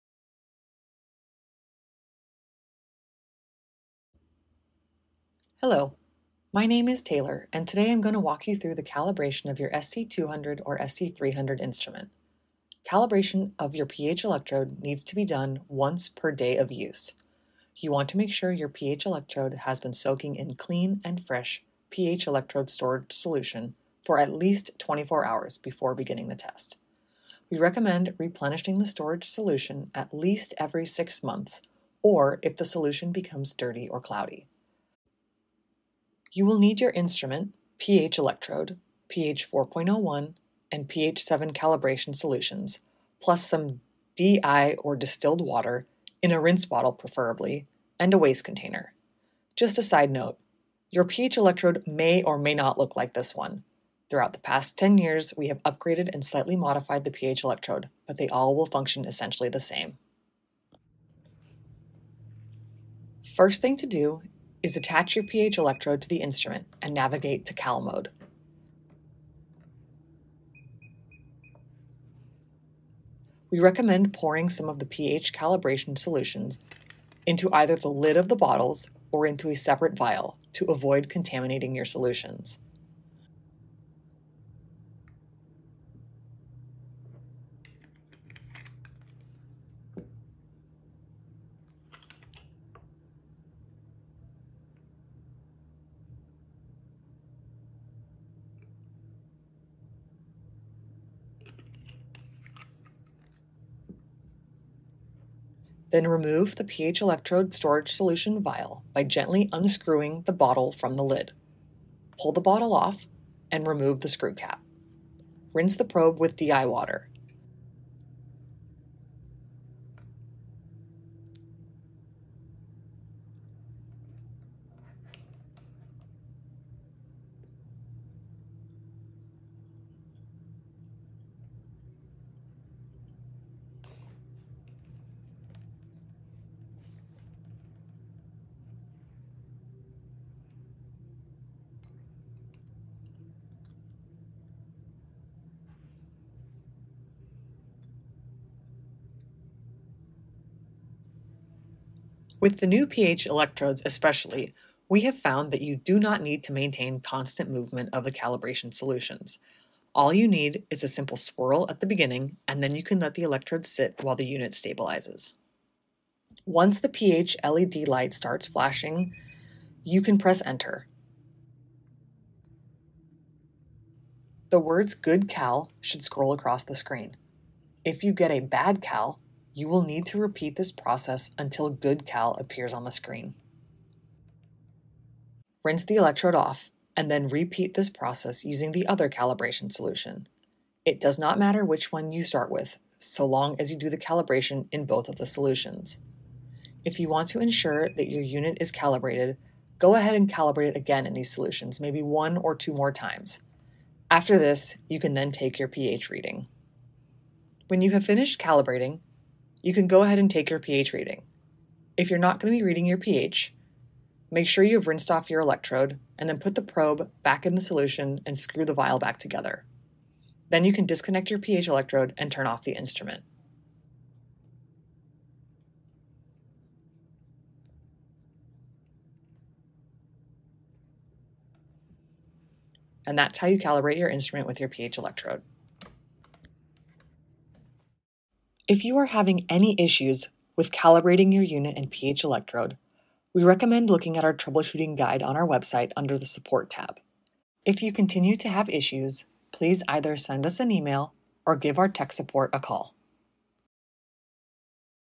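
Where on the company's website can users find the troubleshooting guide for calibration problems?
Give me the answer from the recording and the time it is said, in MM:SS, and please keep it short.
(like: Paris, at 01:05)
Support tab, at 04:06.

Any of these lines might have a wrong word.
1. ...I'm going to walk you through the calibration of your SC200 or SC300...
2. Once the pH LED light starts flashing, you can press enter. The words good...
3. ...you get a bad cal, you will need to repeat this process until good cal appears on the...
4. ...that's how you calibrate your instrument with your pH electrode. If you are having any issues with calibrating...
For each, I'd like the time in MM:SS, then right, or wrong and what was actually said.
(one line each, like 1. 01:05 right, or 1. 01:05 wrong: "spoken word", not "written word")
1. 00:07 right
2. 02:46 right
3. 02:58 right
4. 03:53 right.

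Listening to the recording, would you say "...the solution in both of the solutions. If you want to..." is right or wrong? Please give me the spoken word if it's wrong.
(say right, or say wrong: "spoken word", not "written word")
wrong: "calibration", not "solution".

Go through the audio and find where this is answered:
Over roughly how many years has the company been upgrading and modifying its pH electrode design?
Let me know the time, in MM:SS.
00:54.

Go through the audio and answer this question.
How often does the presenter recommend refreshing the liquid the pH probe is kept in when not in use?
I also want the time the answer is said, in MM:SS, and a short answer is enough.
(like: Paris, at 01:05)
Every 6 months, at 00:30.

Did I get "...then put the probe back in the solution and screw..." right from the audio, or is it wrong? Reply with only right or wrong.
right.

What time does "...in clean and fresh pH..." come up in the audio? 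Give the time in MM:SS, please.
00:20.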